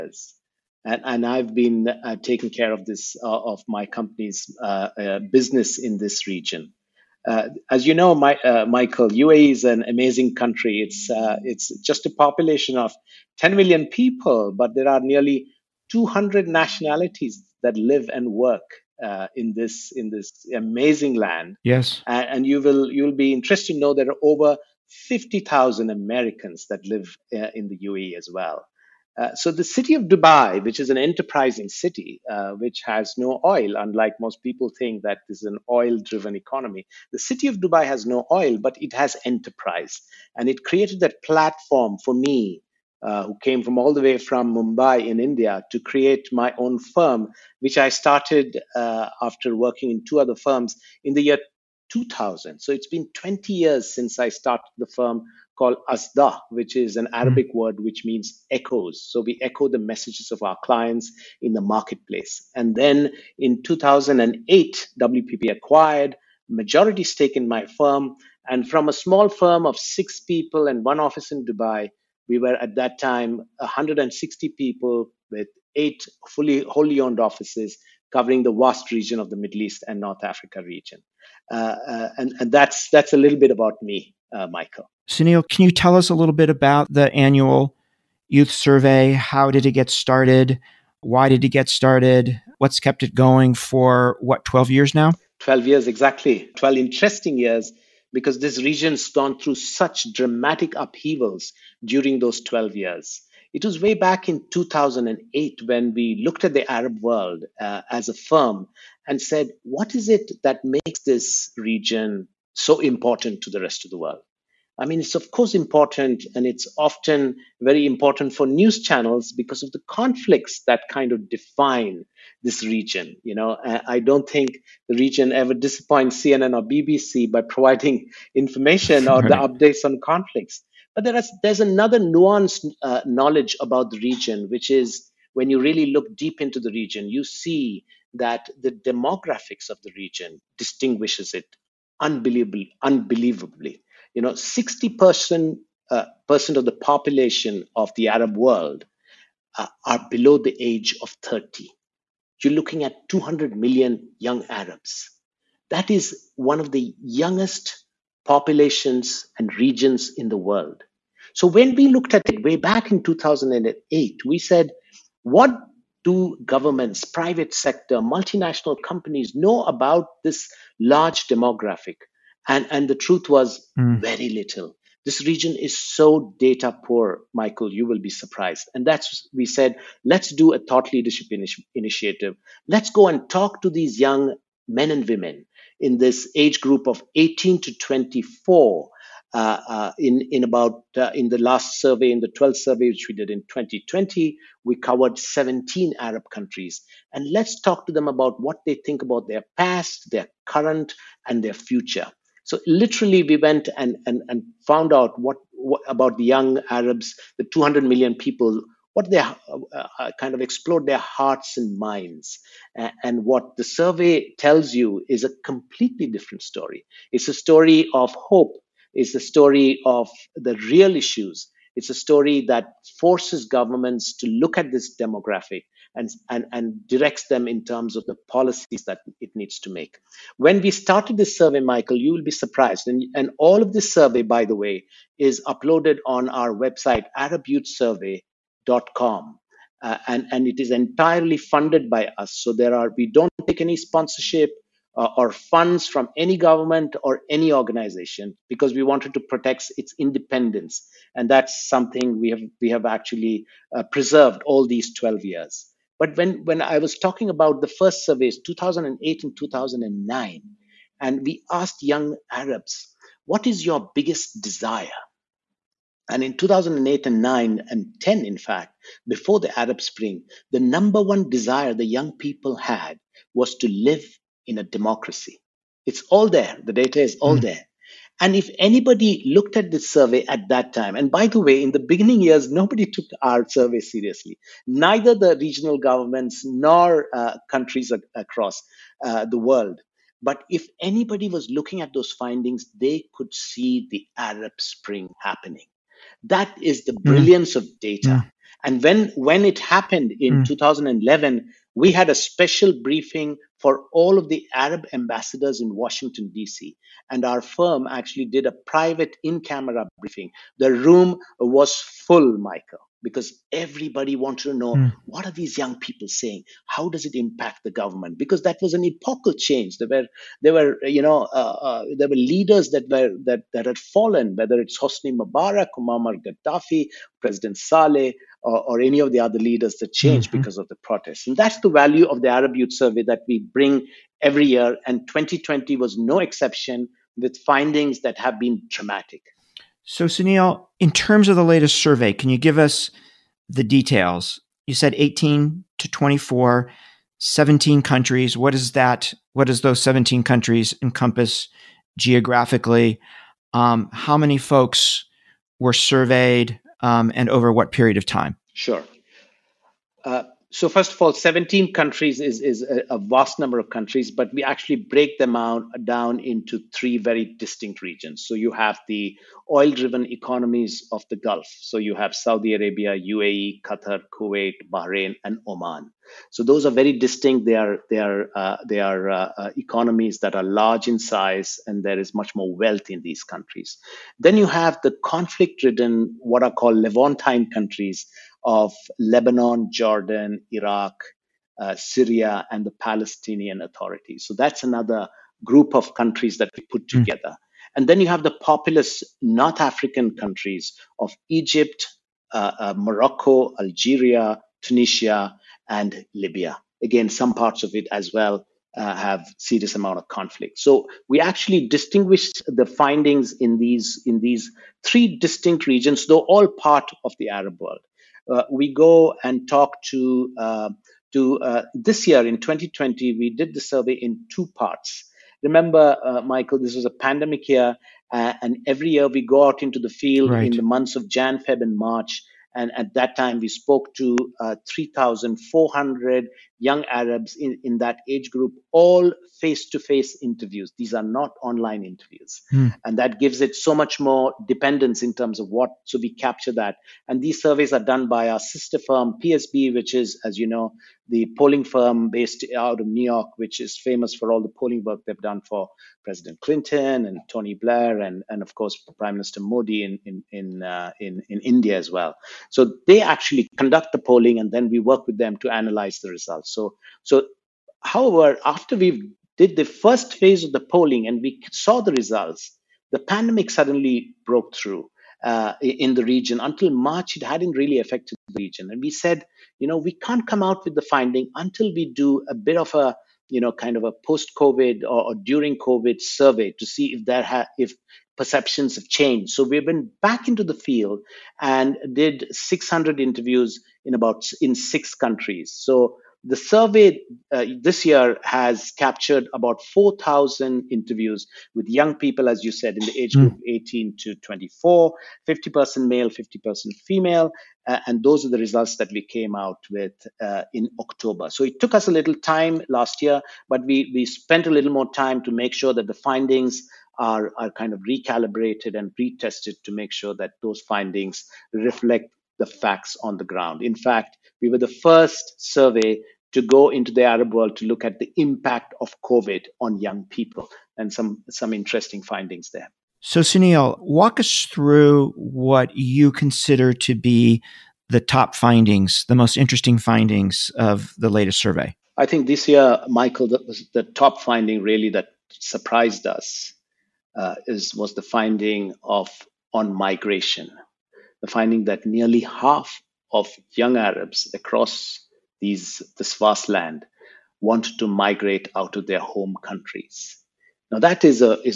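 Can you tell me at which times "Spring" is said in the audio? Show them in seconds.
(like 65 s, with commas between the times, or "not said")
269 s, 294 s.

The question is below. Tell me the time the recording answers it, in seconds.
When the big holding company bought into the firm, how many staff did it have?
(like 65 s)
73 s.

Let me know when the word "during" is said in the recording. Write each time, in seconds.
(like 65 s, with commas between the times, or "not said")
101 s, 485 s.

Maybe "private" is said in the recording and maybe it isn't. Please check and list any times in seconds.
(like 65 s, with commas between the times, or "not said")
167 s, 308 s.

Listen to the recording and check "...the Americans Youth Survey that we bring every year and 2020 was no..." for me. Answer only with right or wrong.
wrong.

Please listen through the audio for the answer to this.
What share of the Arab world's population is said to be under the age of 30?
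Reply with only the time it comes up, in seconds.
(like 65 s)
144 s.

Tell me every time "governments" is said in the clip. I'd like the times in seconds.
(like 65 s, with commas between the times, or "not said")
166 s, 223 s, 246 s, 285 s, 317 s.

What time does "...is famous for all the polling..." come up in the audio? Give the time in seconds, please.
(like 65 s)
453 s.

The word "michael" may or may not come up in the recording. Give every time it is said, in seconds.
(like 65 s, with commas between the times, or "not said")
8 s, 84 s, 177 s, 231 s, 312 s, 426 s, 542 s.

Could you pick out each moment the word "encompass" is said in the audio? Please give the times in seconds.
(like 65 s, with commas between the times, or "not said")
350 s.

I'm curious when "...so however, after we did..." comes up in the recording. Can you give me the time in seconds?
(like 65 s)
467 s.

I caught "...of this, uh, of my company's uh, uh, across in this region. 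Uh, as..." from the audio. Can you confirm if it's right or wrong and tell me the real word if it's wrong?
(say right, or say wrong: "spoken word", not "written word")
wrong: "business", not "across".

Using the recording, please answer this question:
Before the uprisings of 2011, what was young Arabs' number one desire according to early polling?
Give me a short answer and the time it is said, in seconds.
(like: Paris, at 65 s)
To live in a democracy, at 273 s.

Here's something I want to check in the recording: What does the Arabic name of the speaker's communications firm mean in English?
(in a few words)
Echoes.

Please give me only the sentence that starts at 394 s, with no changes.
So that's another group of countries that we put hmm.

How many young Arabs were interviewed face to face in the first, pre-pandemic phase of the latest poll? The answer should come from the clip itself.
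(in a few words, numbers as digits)
3,400.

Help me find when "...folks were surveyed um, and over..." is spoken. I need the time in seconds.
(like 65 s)
354 s.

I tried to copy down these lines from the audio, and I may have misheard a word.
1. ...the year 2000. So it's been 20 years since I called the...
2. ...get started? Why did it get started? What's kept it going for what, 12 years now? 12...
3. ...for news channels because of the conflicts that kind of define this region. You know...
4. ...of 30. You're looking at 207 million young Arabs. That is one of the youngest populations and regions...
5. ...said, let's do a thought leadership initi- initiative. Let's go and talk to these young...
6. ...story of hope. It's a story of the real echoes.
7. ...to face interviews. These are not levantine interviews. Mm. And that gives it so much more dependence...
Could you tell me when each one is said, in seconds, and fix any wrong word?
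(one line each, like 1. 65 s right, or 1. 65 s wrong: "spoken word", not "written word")
1. 51 s wrong: "started", not "called"
2. 89 s right
3. 118 s right
4. 151 s wrong: "200", not "207"
5. 179 s right
6. 217 s wrong: "issues", not "echoes"
7. 439 s wrong: "online", not "levantine".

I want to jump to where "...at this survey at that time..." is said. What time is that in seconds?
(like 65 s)
279 s.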